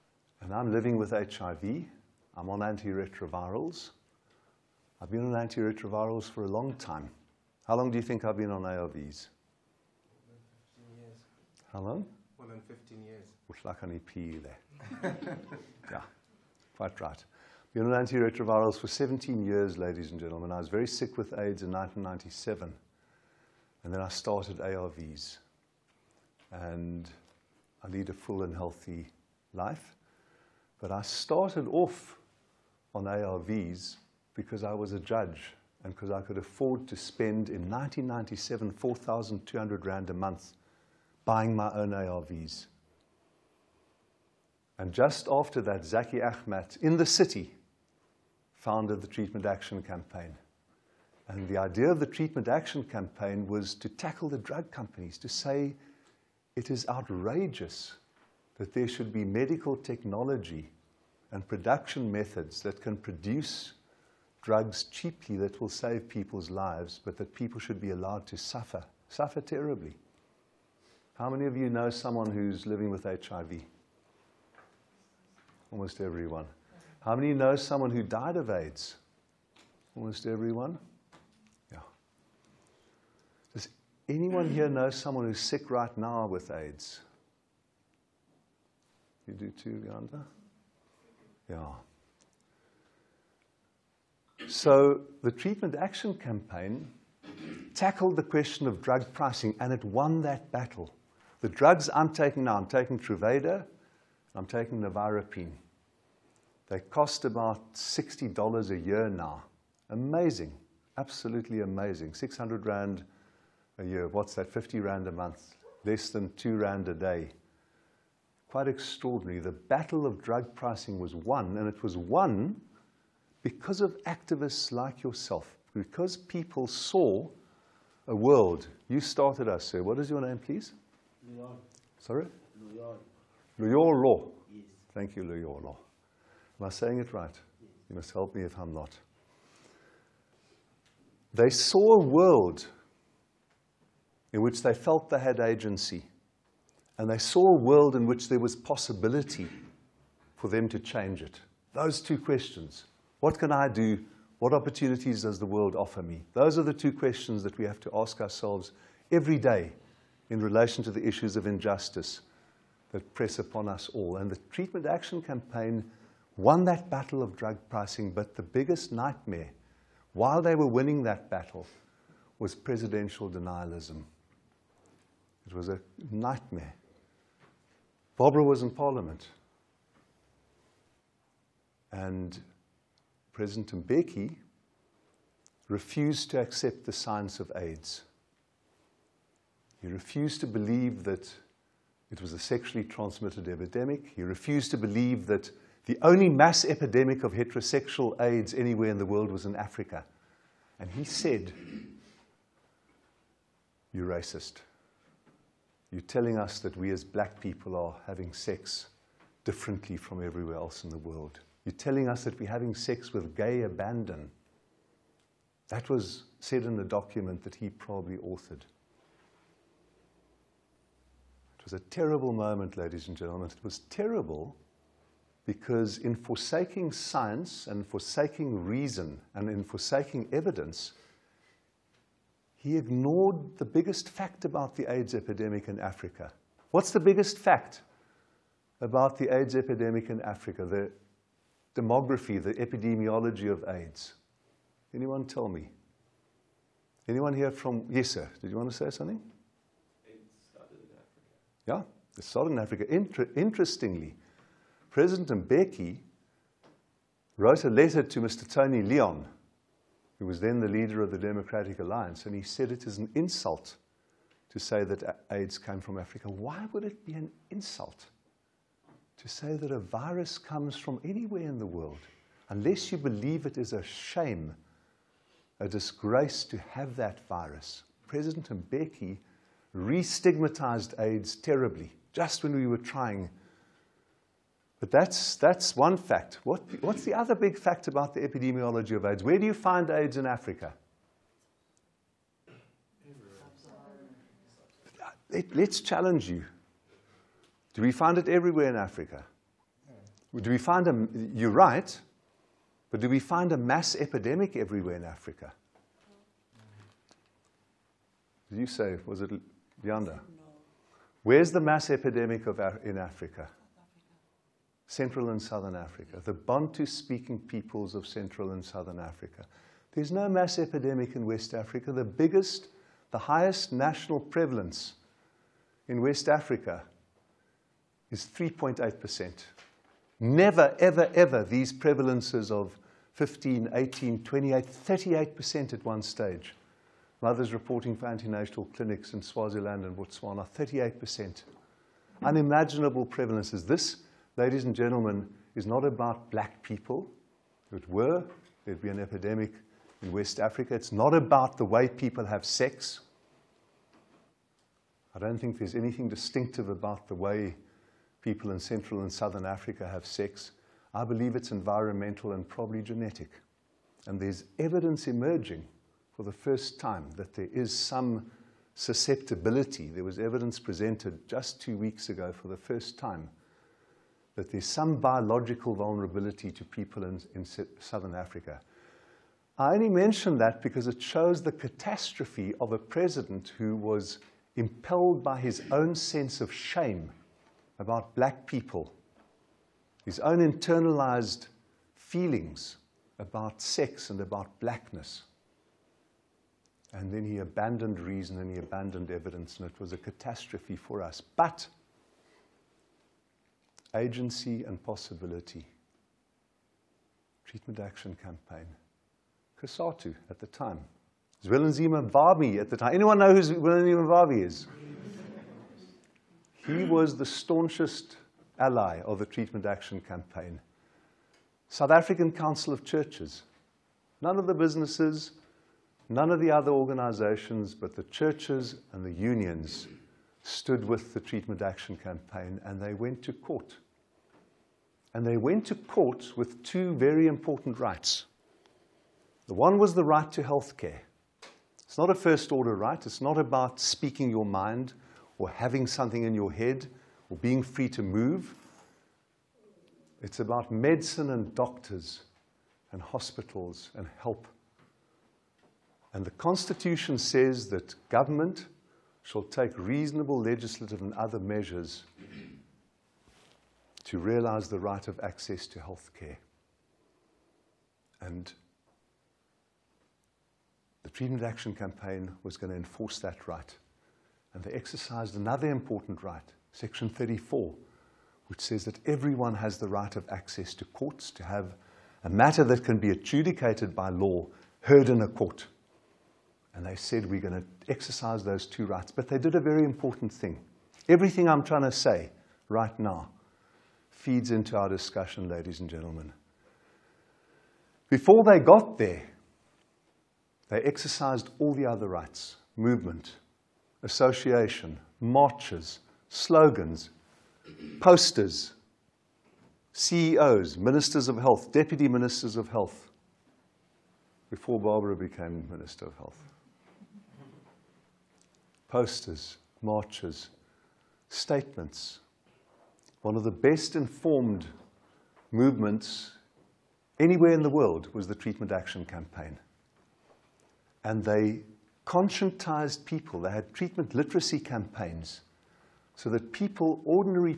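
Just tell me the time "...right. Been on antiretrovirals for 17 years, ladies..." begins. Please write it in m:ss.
0:16.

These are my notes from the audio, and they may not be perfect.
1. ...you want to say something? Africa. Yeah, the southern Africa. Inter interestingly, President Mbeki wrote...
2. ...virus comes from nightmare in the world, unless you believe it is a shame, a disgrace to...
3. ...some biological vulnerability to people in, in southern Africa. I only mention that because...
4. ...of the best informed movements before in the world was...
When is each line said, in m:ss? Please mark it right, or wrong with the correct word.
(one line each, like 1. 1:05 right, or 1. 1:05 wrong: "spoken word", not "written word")
1. 4:08 right
2. 4:29 wrong: "anywhere", not "nightmare"
3. 6:14 right
4. 8:43 wrong: "anywhere", not "before".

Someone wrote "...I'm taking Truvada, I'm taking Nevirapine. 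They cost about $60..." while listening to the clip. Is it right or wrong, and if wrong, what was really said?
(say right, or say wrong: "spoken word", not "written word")
right.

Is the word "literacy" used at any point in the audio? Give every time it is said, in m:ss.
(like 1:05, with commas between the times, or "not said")
8:54.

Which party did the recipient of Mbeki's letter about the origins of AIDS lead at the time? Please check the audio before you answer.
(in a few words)
Democratic Alliance.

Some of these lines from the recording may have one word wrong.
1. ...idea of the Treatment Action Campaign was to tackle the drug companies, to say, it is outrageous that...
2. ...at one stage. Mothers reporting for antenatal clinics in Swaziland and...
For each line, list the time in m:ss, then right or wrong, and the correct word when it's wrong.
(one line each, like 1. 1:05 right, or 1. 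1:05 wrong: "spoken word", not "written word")
1. 0:51 right
2. 5:35 right.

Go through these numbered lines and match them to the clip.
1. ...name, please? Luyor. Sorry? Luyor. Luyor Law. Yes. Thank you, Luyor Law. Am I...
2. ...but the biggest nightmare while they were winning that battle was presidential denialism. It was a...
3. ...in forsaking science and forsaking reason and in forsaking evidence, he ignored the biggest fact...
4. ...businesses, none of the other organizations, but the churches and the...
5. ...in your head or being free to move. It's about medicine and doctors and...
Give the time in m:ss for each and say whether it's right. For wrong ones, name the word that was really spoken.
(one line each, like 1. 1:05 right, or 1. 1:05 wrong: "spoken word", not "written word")
1. 2:10 right
2. 2:48 right
3. 3:45 right
4. 7:04 right
5. 7:26 right.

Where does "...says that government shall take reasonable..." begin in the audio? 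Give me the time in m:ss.
7:37.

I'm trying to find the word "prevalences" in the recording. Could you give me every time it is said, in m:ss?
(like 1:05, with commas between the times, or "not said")
5:24, 5:31, 5:43.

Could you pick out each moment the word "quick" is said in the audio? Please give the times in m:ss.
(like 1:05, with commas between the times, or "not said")
not said.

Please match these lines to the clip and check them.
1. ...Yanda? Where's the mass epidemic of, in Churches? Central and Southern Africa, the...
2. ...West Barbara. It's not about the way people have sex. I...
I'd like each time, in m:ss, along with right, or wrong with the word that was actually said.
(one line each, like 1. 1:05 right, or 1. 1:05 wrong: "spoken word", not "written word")
1. 5:09 wrong: "Africa", not "Churches"
2. 5:50 wrong: "Africa", not "Barbara".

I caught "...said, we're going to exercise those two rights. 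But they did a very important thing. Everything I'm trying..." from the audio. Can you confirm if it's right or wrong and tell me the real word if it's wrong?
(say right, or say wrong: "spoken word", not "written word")
right.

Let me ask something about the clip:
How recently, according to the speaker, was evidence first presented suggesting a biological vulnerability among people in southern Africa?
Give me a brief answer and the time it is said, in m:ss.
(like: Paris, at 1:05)
two weeks ago, at 6:11.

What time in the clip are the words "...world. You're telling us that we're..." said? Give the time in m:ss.
3:30.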